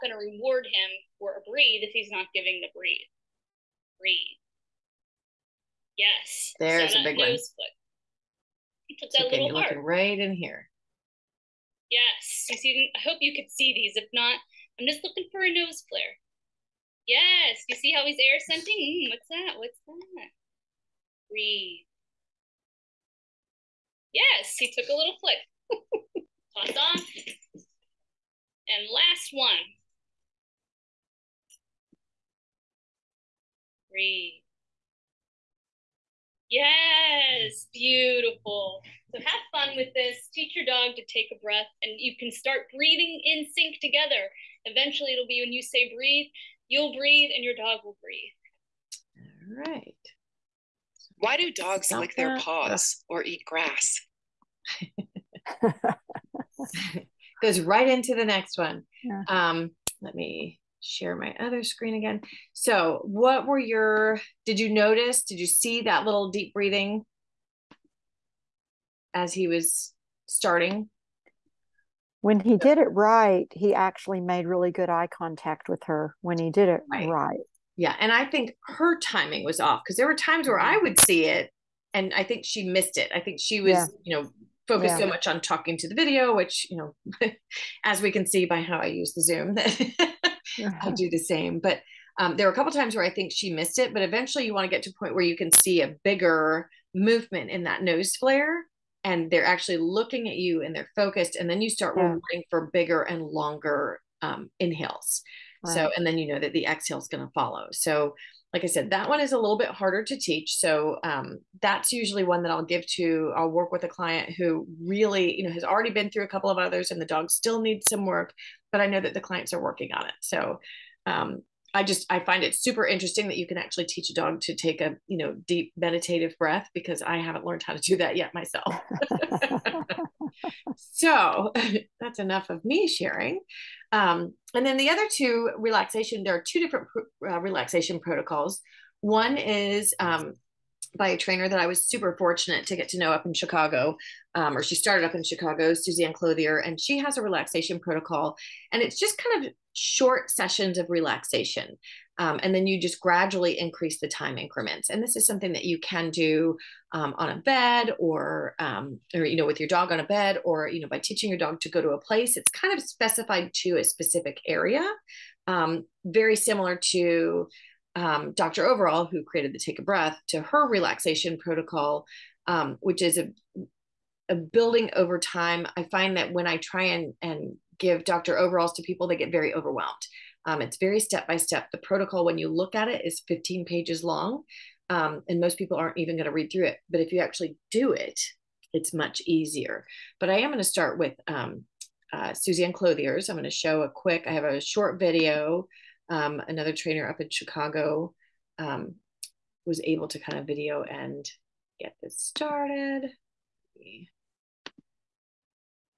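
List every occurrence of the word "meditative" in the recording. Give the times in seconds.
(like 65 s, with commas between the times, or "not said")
125 s.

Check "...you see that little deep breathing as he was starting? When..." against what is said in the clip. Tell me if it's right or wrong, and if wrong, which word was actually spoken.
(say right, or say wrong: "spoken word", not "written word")
right.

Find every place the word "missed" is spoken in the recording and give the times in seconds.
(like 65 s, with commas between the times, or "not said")
82 s, 93 s.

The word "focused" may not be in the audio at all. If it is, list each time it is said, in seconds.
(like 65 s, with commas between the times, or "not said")
84 s, 100 s.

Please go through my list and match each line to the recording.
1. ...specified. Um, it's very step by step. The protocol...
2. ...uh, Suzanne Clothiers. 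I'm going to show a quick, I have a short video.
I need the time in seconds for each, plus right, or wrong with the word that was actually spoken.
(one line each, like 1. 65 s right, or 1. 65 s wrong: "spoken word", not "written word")
1. 179 s wrong: "overwhelmed", not "specified"
2. 192 s right.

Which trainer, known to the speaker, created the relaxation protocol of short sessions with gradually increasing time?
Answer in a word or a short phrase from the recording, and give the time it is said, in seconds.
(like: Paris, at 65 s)
Suzanne Clothier, at 145 s.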